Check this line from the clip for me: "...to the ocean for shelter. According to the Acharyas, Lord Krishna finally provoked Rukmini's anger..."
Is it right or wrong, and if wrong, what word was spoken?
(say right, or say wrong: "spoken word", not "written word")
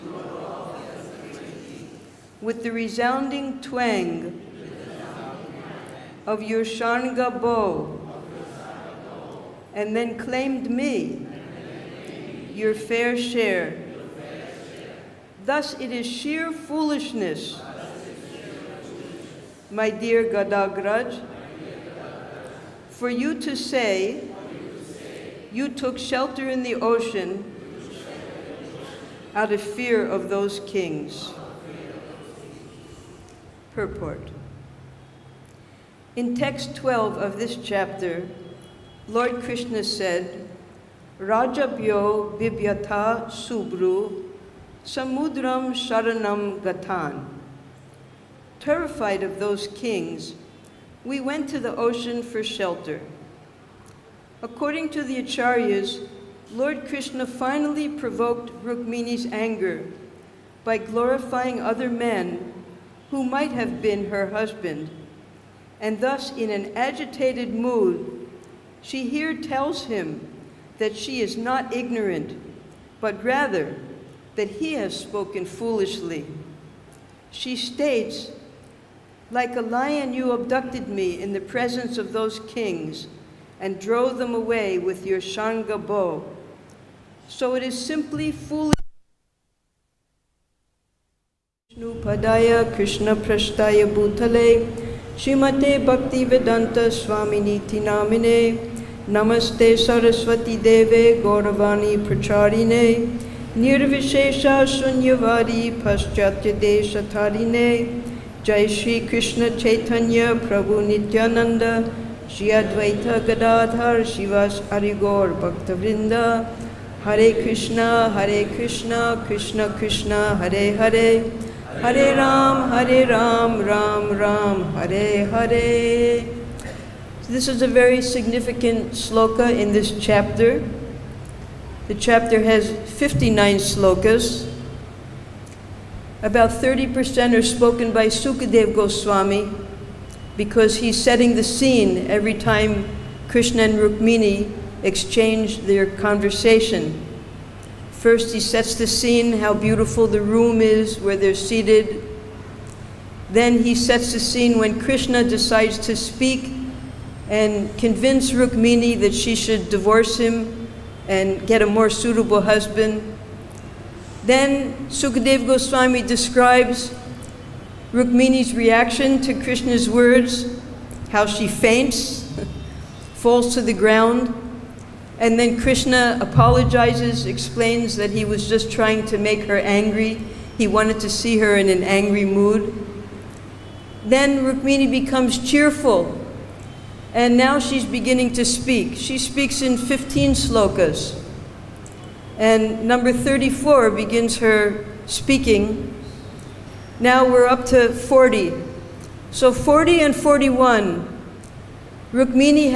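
right.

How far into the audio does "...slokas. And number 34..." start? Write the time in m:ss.
3:10.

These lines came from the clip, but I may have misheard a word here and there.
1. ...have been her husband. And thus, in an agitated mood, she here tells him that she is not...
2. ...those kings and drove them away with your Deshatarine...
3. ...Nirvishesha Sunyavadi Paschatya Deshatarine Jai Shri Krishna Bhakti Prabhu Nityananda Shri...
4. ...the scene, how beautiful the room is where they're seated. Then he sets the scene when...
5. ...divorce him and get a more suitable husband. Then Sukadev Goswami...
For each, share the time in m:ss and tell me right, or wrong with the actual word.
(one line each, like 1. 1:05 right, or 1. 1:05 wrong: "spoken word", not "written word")
1. 1:03 right
2. 1:22 wrong: "Shanga", not "Deshatarine"
3. 1:43 wrong: "Chaitanya", not "Bhakti"
4. 2:28 right
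5. 2:39 right.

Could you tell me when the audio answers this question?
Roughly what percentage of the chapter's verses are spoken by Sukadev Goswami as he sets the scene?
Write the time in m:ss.
2:16.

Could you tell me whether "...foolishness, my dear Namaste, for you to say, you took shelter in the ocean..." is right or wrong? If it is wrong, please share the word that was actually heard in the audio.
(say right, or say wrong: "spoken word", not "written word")
wrong: "Gadagraj", not "Namaste".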